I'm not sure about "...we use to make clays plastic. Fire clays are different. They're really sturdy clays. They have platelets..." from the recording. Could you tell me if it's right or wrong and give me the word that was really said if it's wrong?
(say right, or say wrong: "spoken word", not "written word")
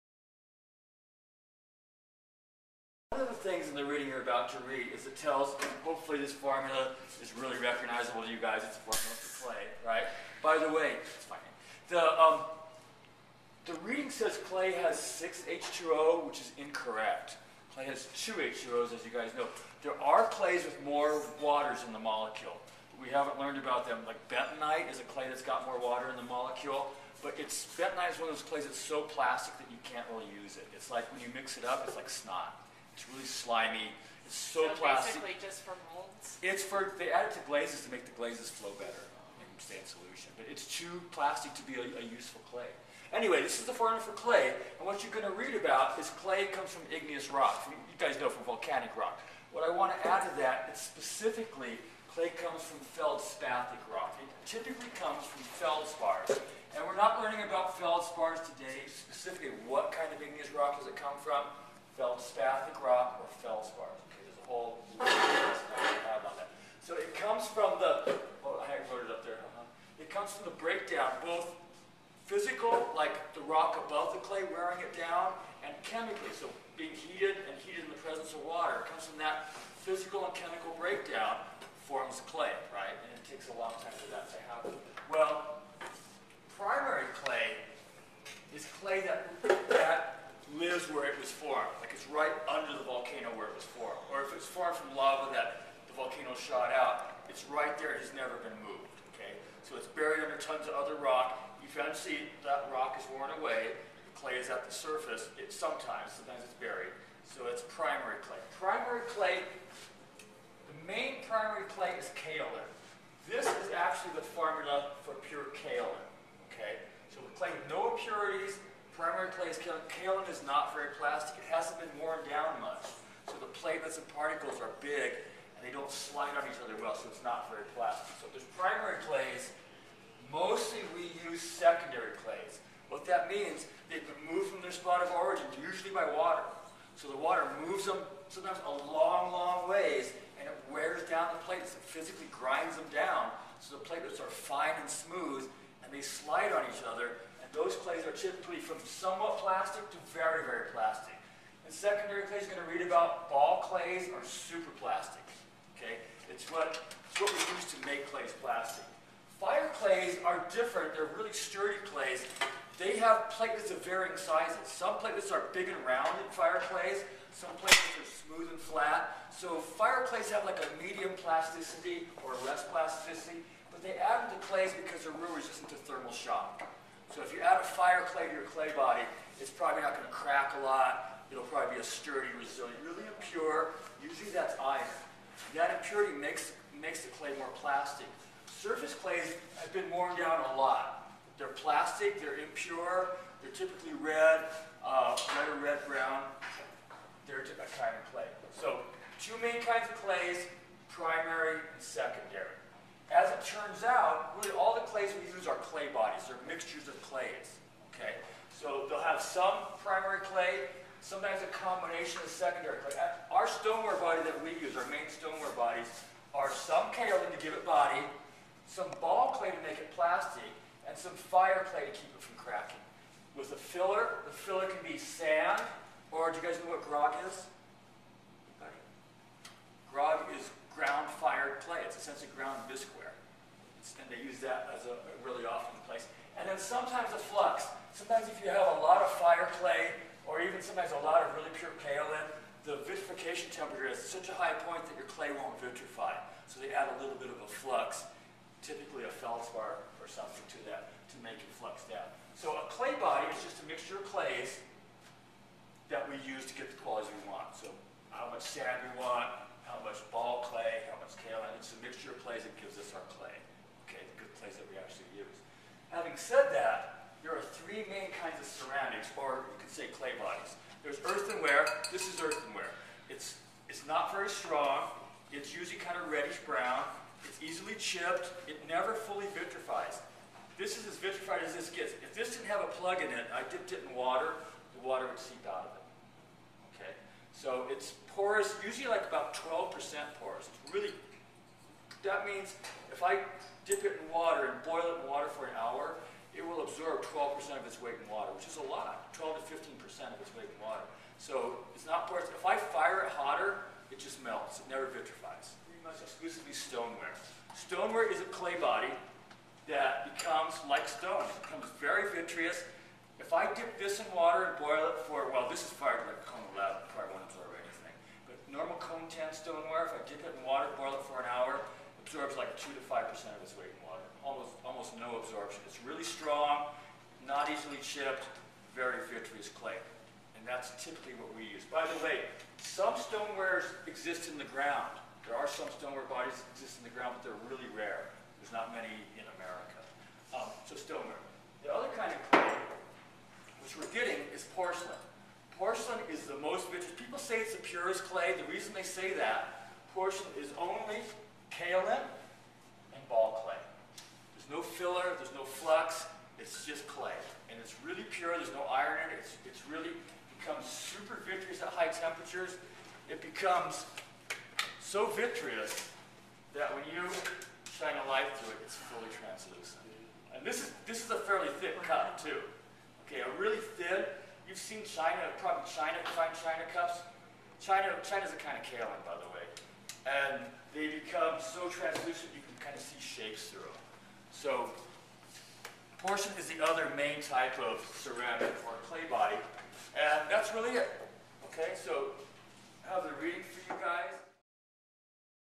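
right.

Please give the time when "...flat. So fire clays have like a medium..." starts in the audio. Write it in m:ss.
2:48.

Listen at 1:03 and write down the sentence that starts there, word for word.
Okay, there's a whole So it comes from the, oh, I wrote it up there.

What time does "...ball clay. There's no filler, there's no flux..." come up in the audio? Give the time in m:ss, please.
5:53.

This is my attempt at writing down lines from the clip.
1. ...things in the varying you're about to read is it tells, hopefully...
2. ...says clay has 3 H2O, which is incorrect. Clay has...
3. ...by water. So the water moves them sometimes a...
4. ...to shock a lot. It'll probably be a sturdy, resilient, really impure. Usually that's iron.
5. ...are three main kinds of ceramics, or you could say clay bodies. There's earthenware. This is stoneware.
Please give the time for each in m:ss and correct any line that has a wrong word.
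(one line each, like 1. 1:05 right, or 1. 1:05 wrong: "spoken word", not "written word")
1. 0:03 wrong: "reading", not "varying"
2. 0:14 wrong: "6", not "3"
3. 2:15 right
4. 3:00 wrong: "crack", not "shock"
5. 4:27 wrong: "earthenware", not "stoneware".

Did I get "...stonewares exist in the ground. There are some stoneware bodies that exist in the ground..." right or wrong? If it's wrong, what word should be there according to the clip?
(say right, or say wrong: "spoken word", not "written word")
right.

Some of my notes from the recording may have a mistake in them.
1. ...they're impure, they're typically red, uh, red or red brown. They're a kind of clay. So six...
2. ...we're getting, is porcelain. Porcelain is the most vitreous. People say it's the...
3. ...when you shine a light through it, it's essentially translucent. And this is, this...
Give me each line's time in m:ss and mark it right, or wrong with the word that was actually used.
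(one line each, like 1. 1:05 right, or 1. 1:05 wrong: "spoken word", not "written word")
1. 3:12 wrong: "two", not "six"
2. 5:43 right
3. 6:06 wrong: "fully", not "essentially".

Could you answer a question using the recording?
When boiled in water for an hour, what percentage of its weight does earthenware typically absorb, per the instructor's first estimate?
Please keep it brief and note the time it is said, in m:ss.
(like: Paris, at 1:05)
12%, at 4:49.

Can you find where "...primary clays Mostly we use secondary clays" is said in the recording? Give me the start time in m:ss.
2:08.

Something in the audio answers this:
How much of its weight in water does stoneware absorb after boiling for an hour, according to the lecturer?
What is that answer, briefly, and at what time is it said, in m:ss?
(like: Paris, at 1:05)
2 to 5%, at 5:22.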